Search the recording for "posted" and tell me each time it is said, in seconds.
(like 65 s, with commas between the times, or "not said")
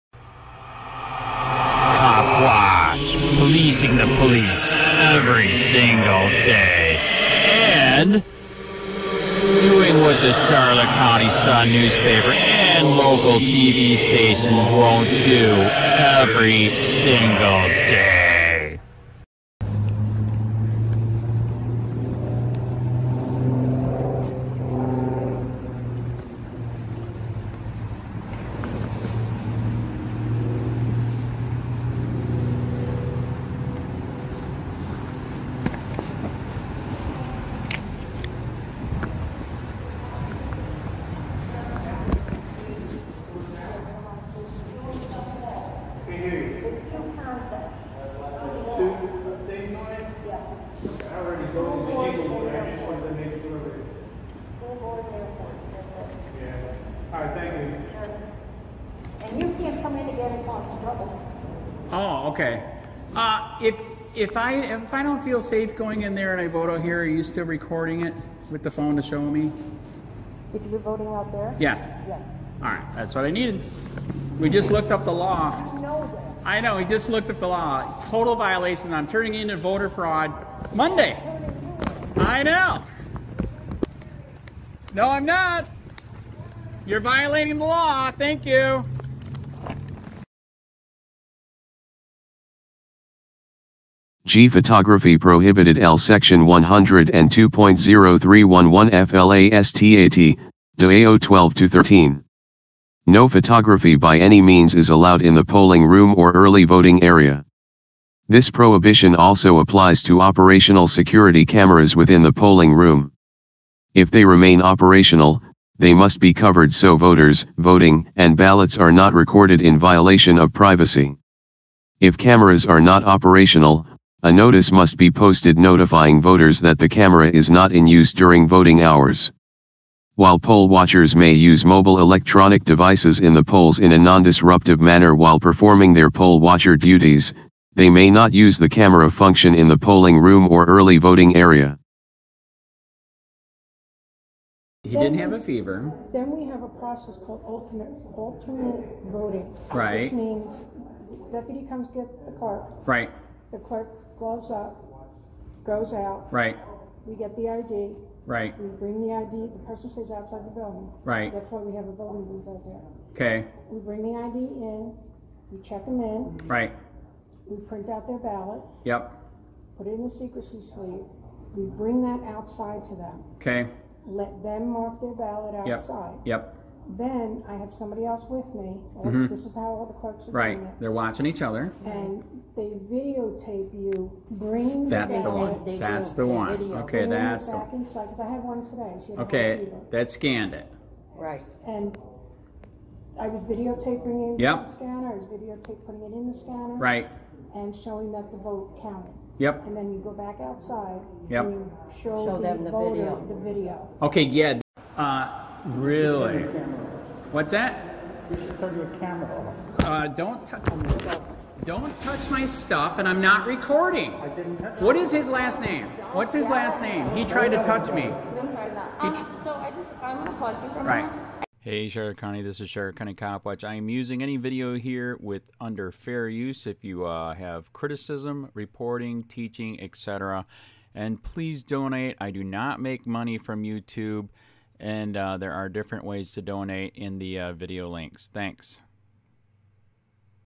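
125 s.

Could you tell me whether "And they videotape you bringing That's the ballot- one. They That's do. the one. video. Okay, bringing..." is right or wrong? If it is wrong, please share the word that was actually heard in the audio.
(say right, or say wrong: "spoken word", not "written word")
right.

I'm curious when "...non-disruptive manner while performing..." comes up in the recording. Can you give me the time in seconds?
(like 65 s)
133 s.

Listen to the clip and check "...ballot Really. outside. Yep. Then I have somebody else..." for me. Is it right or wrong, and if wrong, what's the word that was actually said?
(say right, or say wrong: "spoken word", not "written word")
wrong: "Yep", not "Really".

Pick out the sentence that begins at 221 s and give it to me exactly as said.
Hey, Charlotte County, this is Charlotte County Cop Watch.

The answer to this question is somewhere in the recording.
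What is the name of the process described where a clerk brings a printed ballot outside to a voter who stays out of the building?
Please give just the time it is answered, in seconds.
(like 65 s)
148 s.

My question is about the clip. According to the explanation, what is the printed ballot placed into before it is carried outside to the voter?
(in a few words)
secrecy sleeve.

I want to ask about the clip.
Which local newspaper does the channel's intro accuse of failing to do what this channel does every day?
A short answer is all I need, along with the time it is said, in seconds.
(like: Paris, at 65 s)
Charlotte County Sun, at 10 s.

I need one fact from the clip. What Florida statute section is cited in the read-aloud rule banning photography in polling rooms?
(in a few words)
Section 102.0311.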